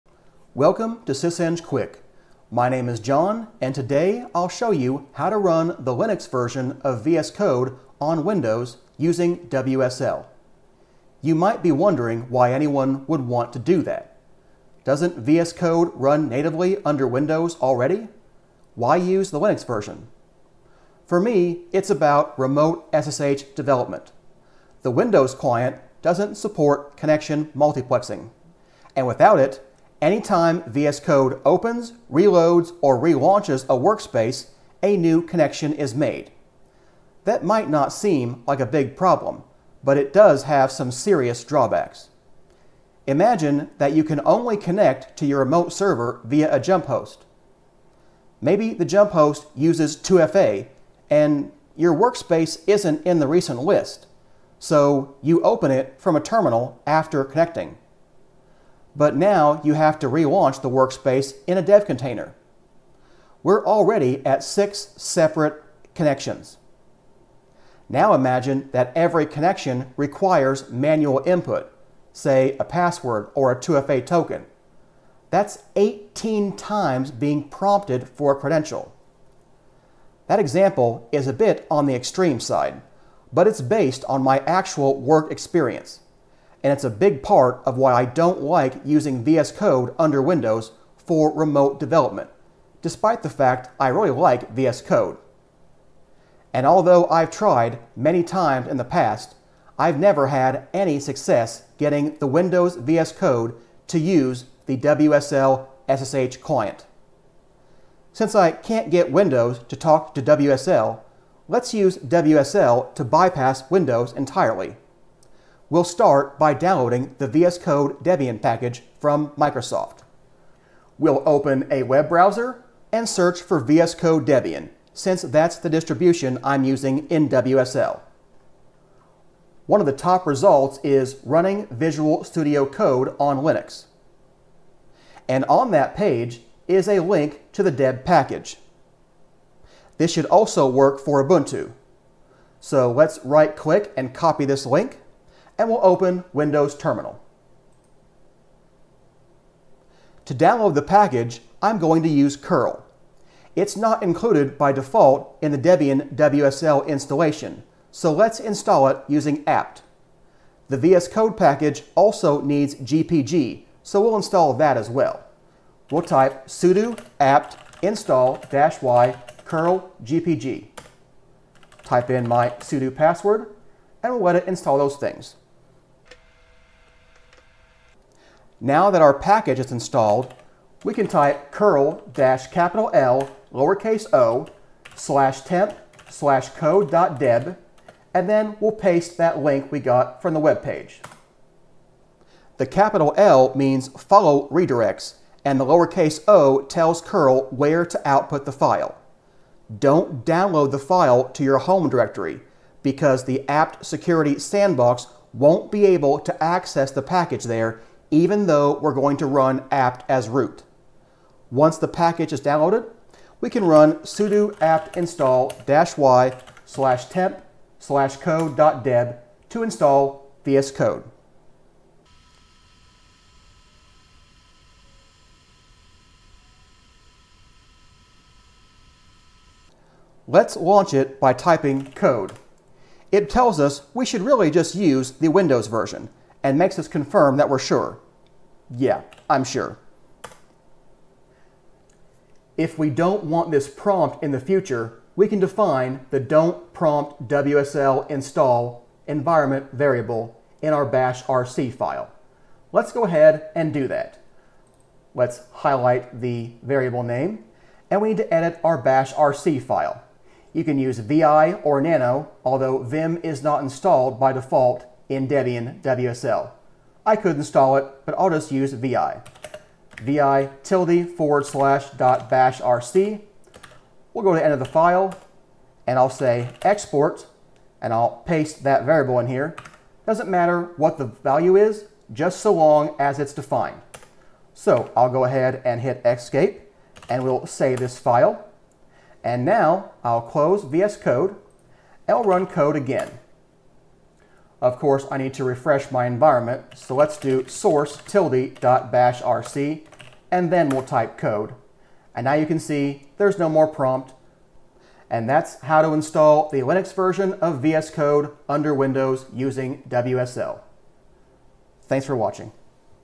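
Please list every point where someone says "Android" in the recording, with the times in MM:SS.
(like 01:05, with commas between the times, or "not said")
not said.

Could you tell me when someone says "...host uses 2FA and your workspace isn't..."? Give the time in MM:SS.
00:49.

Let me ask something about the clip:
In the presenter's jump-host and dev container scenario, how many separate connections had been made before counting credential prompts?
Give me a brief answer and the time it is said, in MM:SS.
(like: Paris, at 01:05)
6, at 01:04.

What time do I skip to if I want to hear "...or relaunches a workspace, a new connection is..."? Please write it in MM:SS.
00:32.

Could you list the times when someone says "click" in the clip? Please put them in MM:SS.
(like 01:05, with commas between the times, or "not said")
02:23.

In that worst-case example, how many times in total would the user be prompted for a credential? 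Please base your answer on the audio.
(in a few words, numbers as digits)
18.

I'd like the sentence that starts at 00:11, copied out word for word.
You might be wondering why anyone would want to do that.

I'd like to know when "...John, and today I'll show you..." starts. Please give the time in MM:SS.
00:02.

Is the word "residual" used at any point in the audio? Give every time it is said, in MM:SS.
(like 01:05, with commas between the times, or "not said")
not said.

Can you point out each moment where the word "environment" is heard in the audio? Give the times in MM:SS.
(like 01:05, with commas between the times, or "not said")
04:09, 04:56.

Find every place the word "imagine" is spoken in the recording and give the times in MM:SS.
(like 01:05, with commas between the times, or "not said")
00:43, 01:08.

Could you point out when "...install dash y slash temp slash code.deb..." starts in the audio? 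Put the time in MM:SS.
03:34.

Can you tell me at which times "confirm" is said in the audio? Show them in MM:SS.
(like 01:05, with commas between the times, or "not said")
03:56.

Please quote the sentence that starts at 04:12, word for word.
Let's go ahead and do that.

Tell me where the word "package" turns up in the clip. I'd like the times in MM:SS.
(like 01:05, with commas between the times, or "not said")
01:58, 02:18, 02:30, 02:41, 02:59, 03:27, 03:31.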